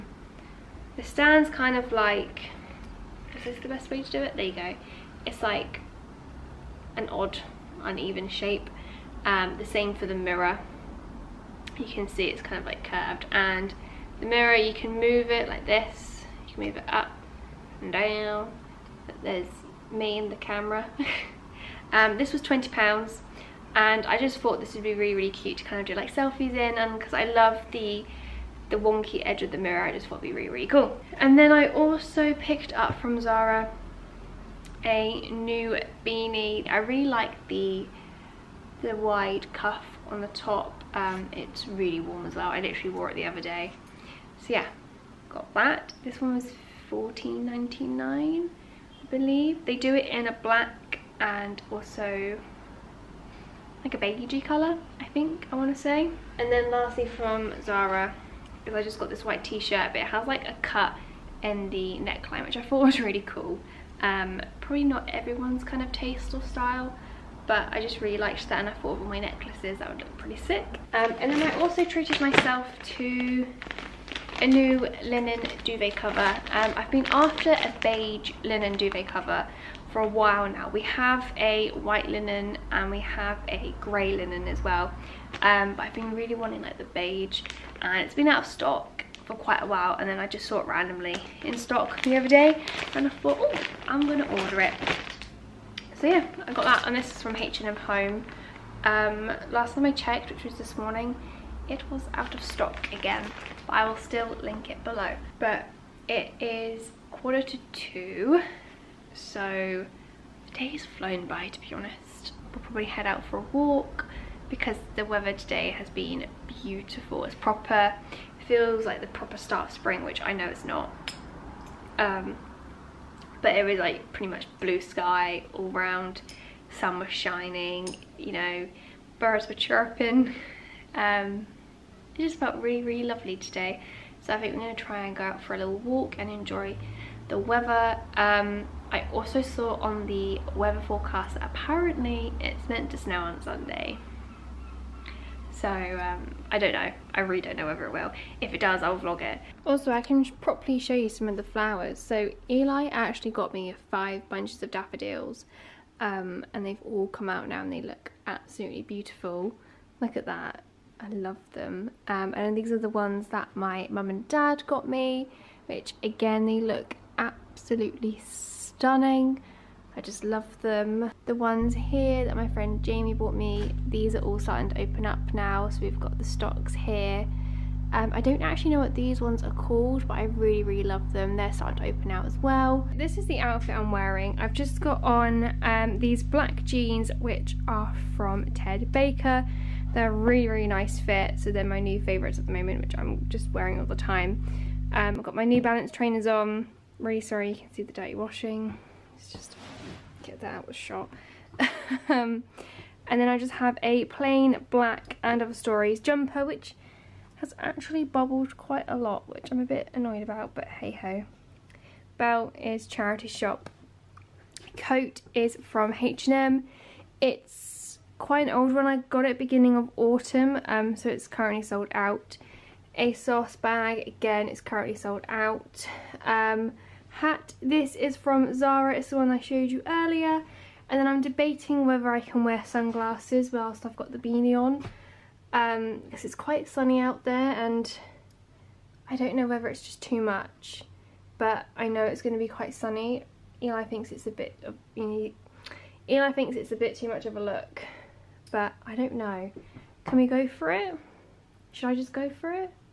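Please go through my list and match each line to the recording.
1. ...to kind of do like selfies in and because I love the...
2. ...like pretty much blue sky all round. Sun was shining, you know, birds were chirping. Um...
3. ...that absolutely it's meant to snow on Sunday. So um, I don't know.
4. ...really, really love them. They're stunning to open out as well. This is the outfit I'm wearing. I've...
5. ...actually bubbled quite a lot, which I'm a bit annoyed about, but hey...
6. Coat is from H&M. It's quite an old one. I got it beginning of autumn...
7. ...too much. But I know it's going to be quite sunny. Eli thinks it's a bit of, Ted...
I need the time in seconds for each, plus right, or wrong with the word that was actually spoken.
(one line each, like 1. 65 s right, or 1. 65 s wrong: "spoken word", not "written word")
1. 25 s right
2. 123 s right
3. 141 s wrong: "apparently", not "absolutely"
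4. 180 s wrong: "starting", not "stunning"
5. 207 s right
6. 214 s right
7. 240 s wrong: "Eli", not "Ted".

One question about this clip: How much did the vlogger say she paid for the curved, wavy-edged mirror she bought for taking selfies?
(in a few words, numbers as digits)
20 pounds.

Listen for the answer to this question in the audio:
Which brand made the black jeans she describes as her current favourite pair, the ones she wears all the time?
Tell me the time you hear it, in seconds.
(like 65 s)
188 s.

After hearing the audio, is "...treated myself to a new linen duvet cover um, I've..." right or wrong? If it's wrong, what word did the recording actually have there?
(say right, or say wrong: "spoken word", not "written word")
right.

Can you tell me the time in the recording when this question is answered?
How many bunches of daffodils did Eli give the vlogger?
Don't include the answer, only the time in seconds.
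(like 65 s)
153 s.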